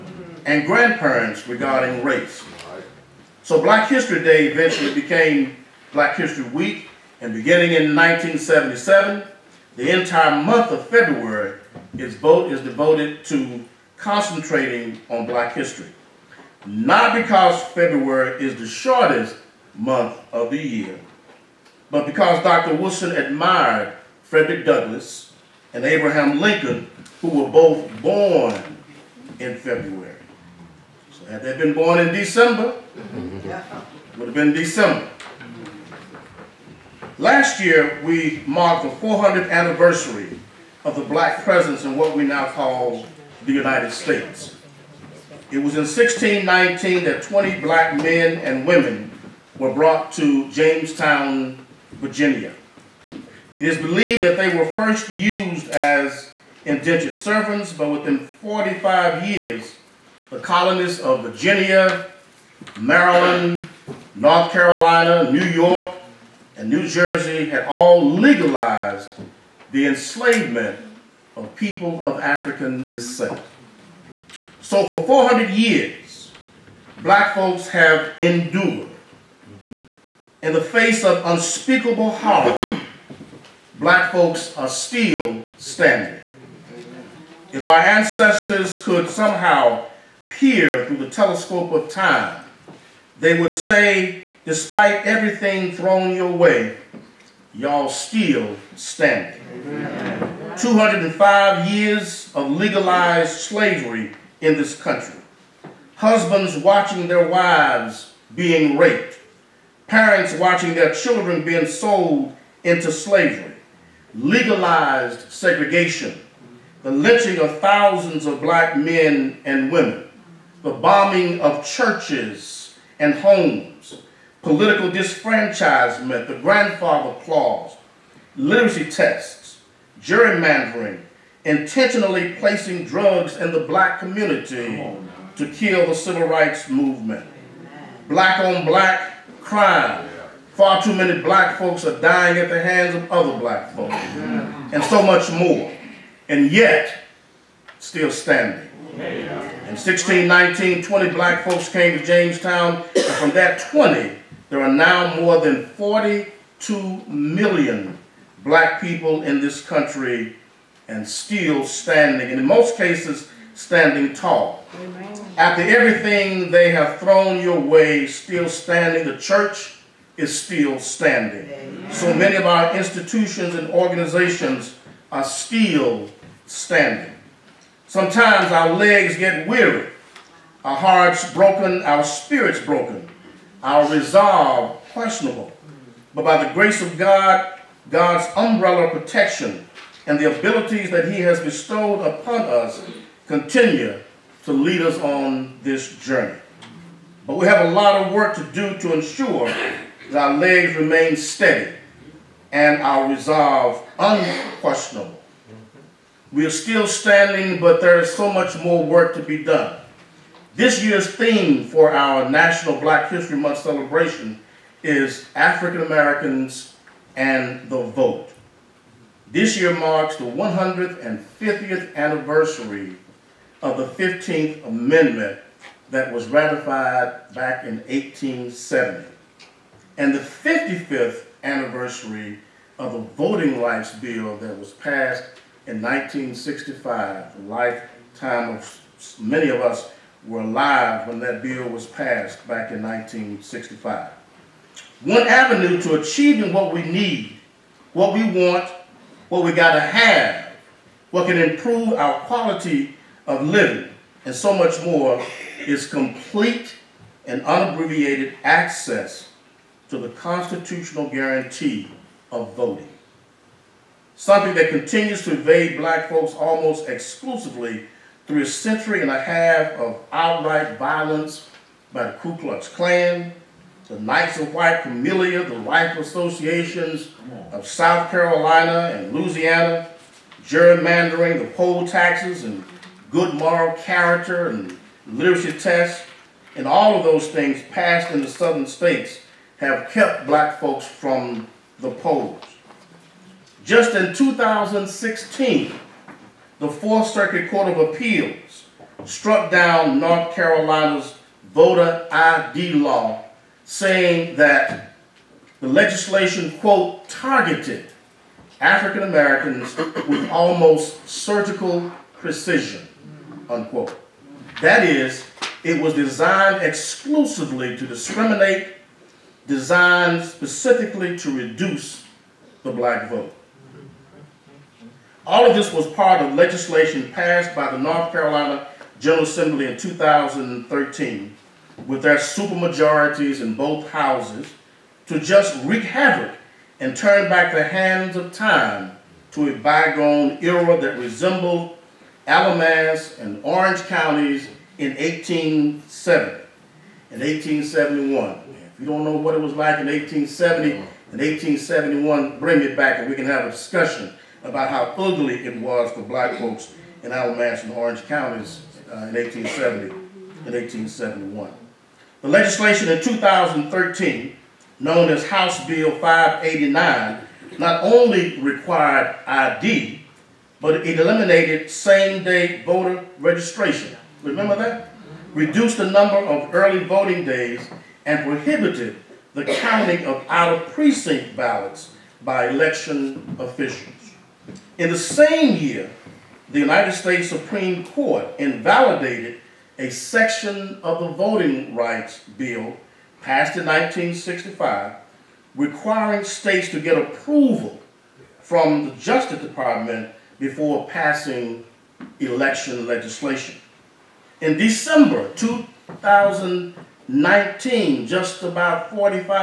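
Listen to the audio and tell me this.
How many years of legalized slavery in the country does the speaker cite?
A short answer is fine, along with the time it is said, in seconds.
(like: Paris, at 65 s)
205, at 100 s.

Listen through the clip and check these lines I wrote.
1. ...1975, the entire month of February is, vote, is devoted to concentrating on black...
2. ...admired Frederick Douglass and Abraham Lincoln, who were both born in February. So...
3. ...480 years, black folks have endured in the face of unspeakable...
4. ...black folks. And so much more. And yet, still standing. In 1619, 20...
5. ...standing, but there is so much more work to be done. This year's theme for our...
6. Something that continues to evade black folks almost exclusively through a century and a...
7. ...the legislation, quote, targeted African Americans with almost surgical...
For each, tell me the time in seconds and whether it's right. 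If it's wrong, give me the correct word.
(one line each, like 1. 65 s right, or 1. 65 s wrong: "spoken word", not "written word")
1. 7 s wrong: "1977", not "1975"
2. 23 s right
3. 75 s wrong: "400", not "480"
4. 143 s right
5. 206 s right
6. 264 s right
7. 305 s right.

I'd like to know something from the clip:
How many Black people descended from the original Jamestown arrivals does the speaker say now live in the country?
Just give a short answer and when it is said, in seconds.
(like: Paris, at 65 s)
42 million, at 155 s.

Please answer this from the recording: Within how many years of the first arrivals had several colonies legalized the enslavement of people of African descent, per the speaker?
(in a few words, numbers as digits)
45 years.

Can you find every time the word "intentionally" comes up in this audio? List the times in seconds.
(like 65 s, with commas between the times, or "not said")
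131 s.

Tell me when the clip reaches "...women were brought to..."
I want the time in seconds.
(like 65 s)
48 s.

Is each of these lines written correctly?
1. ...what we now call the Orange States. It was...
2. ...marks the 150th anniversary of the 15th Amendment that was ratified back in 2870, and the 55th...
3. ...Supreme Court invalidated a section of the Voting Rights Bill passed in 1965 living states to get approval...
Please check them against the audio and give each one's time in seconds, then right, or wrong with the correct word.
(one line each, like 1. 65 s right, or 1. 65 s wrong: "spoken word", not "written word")
1. 41 s wrong: "United", not "Orange"
2. 219 s wrong: "1870", not "2870"
3. 387 s wrong: "requiring", not "living".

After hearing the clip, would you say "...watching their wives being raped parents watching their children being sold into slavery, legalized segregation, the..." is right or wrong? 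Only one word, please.
right.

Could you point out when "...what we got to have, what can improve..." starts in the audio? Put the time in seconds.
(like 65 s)
249 s.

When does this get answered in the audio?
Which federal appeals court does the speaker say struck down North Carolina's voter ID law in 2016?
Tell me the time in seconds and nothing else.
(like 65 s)
296 s.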